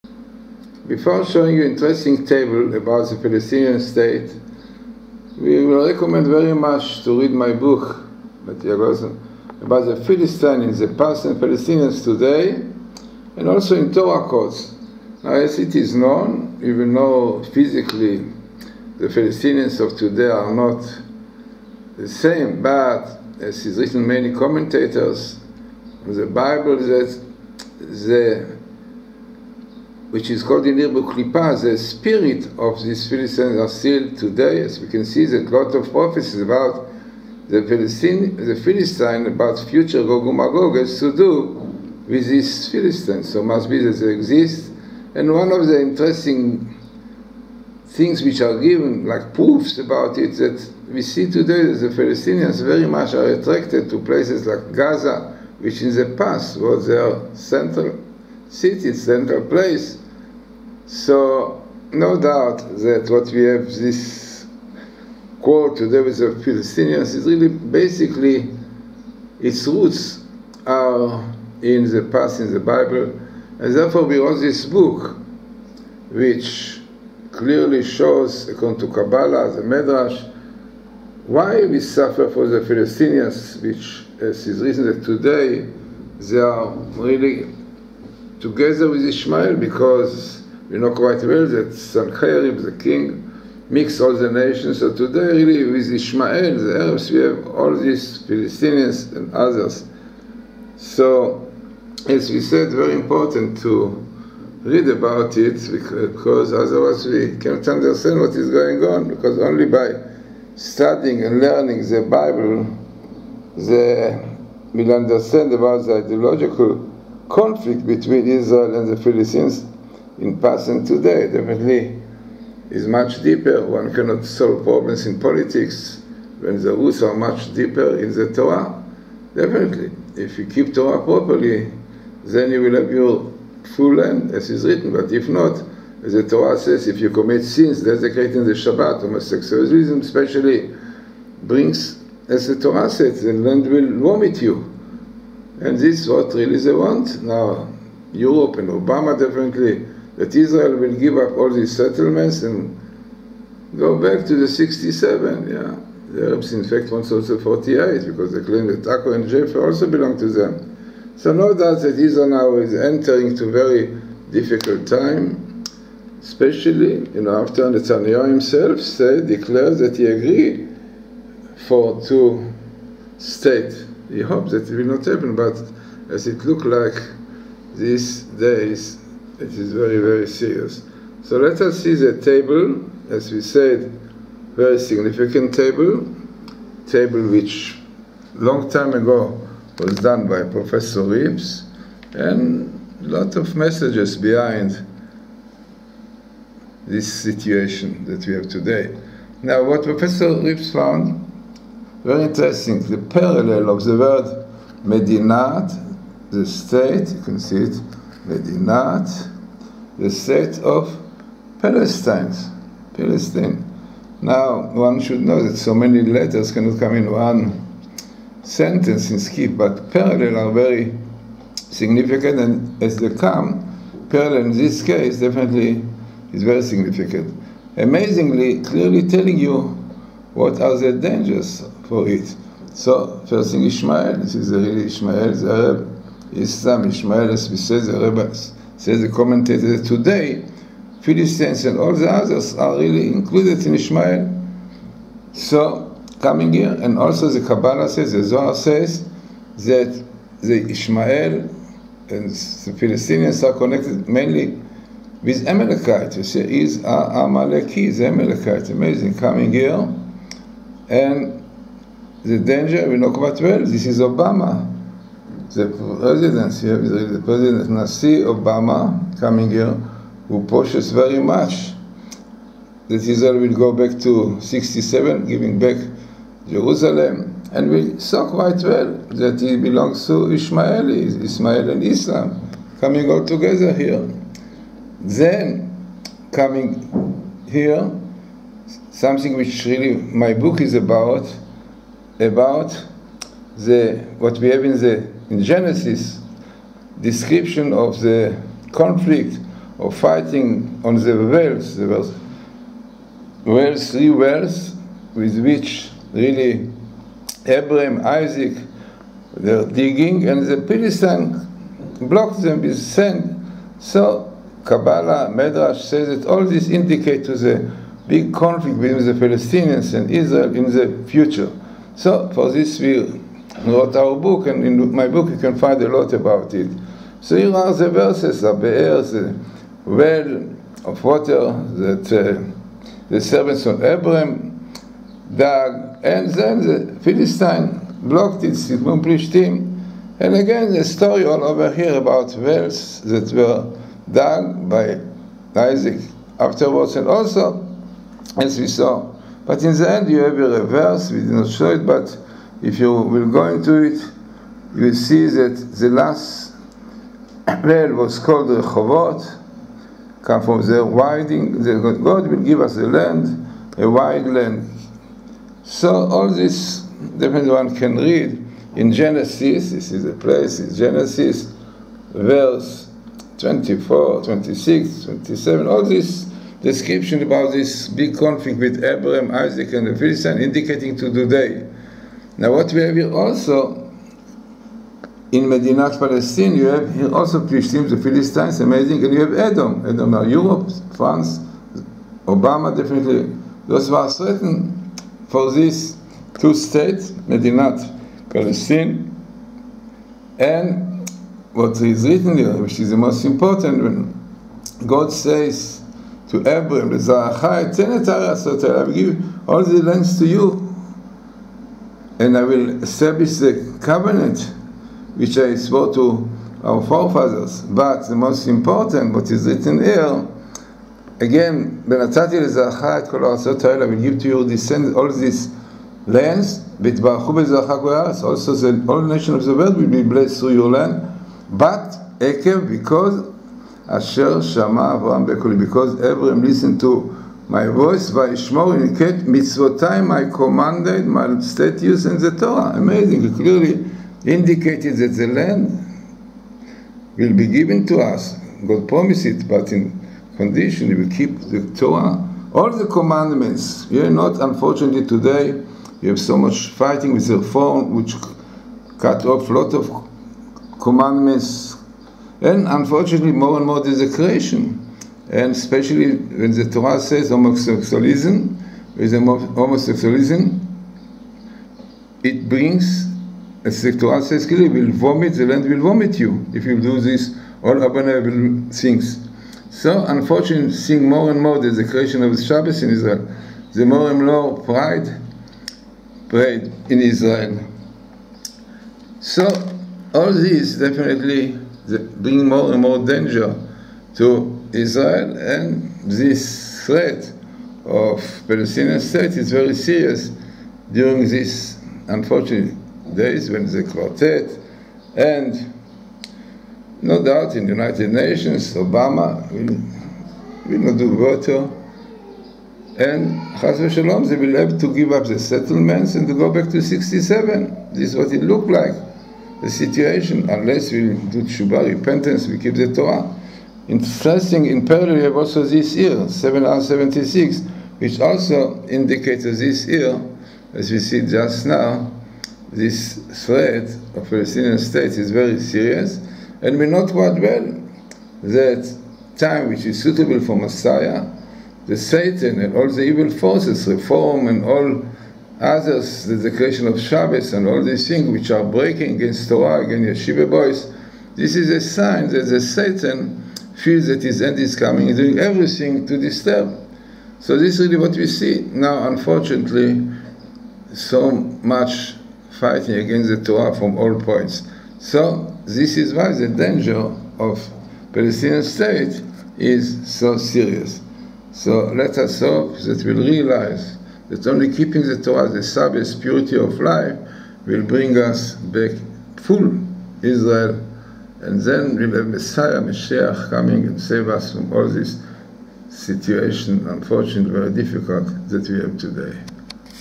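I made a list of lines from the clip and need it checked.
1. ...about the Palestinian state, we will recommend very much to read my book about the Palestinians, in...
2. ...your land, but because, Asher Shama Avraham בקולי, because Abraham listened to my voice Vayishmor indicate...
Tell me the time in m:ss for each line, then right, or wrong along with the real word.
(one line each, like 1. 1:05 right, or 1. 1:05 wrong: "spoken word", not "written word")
1. 0:02 right
2. 7:10 right.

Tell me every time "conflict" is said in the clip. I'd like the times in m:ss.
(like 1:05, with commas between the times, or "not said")
1:57, 4:58, 5:18, 6:18.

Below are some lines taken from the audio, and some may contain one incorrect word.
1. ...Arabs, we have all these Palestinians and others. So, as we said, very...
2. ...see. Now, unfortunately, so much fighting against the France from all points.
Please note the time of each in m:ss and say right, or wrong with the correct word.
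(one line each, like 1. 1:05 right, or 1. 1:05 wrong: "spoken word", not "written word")
1. 1:36 right
2. 9:18 wrong: "Torah", not "France".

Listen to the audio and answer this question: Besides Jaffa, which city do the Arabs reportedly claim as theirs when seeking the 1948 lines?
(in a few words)
Akko.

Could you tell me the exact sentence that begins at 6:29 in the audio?
Edom are Europe, France, Obama definitely.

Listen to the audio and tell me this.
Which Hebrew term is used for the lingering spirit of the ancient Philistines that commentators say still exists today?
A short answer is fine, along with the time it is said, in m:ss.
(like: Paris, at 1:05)
Klipa, at 0:31.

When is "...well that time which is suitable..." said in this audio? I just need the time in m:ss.
8:57.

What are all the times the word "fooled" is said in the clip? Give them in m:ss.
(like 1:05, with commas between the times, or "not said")
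not said.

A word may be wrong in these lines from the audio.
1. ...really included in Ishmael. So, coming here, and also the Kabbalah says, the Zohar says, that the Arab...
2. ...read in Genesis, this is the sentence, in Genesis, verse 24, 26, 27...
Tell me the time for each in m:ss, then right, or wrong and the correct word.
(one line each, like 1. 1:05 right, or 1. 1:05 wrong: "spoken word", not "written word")
1. 4:02 wrong: "Ishmael", not "Arab"
2. 6:07 wrong: "place", not "sentence".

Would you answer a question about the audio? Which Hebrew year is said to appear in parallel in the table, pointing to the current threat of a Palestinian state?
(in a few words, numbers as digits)
776.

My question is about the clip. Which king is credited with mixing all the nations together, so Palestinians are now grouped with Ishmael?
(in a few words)
Sancherib.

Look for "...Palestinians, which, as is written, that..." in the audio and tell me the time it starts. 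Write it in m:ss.
1:22.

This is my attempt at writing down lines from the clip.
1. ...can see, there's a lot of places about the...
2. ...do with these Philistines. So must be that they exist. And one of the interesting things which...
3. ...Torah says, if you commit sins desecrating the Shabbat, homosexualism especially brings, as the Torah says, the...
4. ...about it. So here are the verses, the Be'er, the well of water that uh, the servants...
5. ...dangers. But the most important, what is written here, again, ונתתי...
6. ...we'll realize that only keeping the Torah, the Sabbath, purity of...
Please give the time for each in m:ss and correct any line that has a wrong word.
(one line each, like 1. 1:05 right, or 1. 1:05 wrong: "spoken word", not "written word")
1. 0:34 wrong: "prophecies", not "places"
2. 0:41 right
3. 2:16 right
4. 5:26 right
5. 6:56 wrong: "forefathers", not "dangers"
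6. 9:33 right.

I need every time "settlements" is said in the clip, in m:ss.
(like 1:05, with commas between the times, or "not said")
2:31, 8:35.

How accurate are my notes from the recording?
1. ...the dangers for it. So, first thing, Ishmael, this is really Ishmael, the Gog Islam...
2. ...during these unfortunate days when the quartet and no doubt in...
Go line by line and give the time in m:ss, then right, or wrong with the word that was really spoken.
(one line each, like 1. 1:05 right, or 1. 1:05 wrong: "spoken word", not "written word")
1. 3:50 wrong: "Arab", not "Gog"
2. 8:20 right.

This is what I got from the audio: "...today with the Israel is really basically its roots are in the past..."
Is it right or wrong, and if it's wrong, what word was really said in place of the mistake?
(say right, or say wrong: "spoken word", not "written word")
wrong: "Palestinians", not "Israel".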